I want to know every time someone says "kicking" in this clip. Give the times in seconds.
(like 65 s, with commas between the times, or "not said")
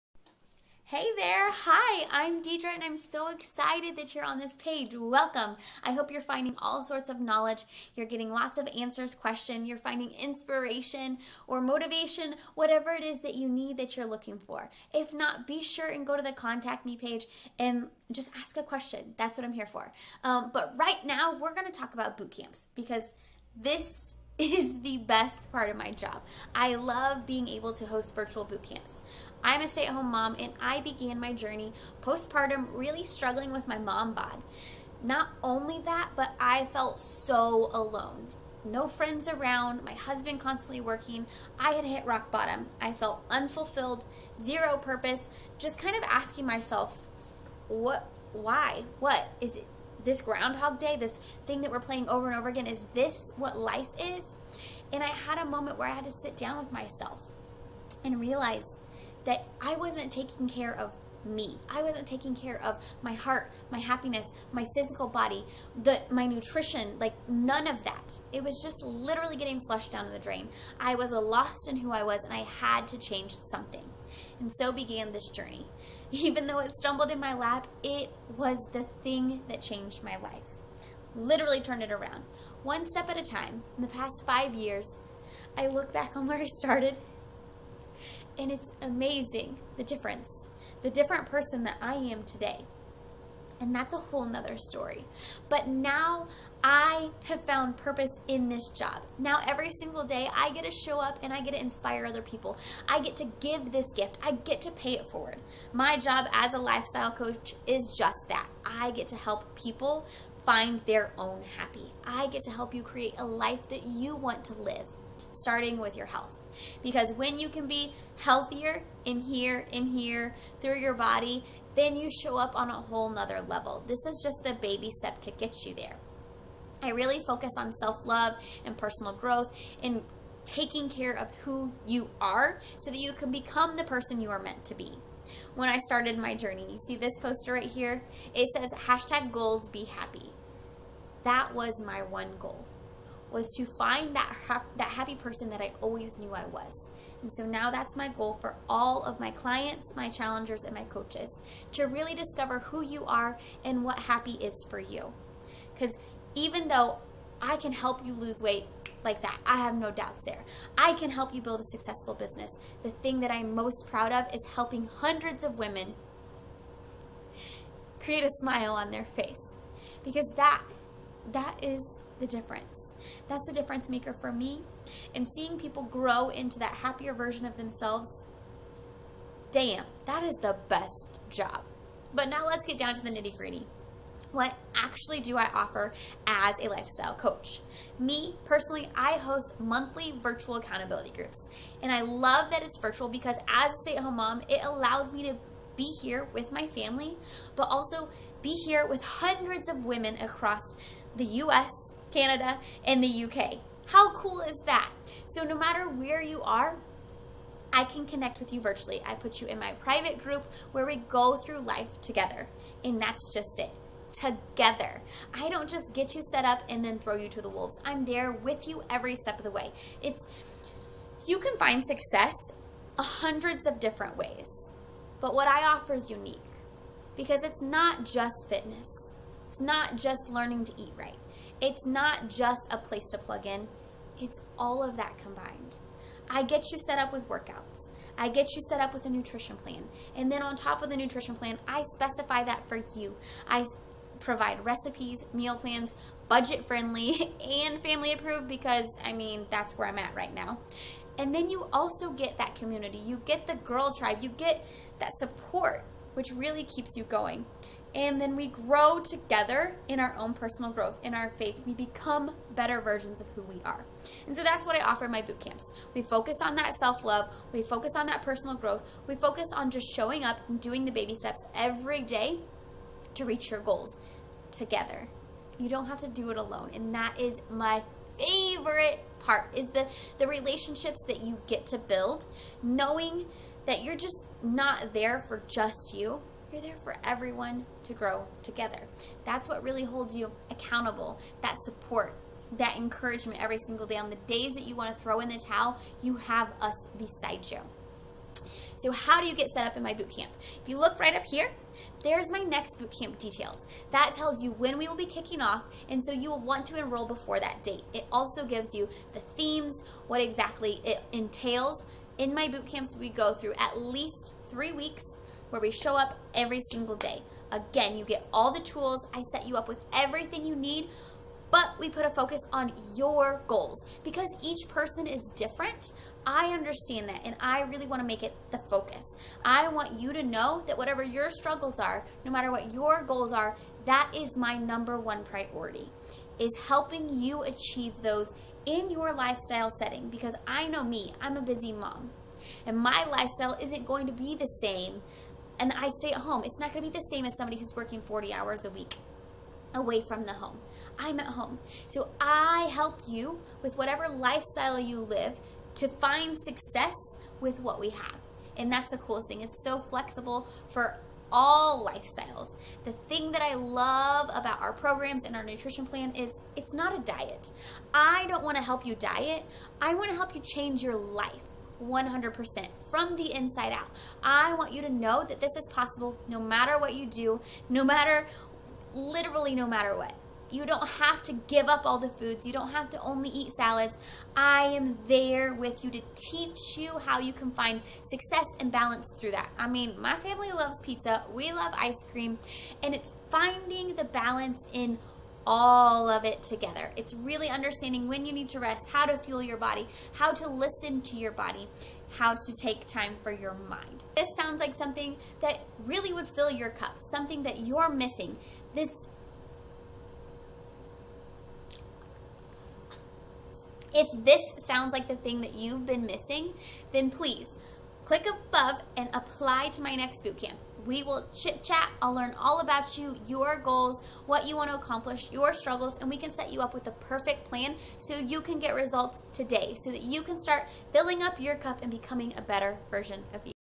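305 s.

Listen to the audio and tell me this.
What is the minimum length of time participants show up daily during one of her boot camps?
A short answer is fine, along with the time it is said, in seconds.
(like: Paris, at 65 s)
3 weeks, at 314 s.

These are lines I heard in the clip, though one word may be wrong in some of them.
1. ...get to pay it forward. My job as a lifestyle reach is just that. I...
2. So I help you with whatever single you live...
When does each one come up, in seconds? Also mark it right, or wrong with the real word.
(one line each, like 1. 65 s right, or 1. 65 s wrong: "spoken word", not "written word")
1. 104 s wrong: "coach", not "reach"
2. 351 s wrong: "lifestyle", not "single".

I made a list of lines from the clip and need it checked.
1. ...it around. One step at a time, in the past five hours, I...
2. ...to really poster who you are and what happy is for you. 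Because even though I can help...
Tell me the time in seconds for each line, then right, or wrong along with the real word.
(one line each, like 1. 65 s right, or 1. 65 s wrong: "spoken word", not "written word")
1. 81 s wrong: "years", not "hours"
2. 151 s wrong: "discover", not "poster".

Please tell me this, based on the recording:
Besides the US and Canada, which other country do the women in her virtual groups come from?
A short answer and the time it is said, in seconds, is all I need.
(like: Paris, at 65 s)
UK, at 203 s.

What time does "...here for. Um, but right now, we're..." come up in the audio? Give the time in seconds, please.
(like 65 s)
19 s.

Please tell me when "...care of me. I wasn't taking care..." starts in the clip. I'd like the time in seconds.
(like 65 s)
60 s.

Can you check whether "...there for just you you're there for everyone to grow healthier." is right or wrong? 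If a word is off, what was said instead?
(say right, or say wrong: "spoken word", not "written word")
wrong: "together", not "healthier".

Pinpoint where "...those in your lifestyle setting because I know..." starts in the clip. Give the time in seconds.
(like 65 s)
338 s.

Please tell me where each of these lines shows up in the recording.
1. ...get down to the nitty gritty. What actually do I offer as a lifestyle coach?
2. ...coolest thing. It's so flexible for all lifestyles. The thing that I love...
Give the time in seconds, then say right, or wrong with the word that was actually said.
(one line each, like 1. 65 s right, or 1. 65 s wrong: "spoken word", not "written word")
1. 182 s right
2. 358 s right.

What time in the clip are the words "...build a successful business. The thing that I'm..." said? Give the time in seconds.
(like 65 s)
161 s.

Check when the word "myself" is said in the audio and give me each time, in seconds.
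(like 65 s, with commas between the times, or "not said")
46 s, 56 s.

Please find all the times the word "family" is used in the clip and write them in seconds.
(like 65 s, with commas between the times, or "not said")
196 s, 247 s, 390 s.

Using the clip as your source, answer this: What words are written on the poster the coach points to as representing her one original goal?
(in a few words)
hashtag goals be happy.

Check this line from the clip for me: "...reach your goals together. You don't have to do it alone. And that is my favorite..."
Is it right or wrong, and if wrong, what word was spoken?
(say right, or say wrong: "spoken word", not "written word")
right.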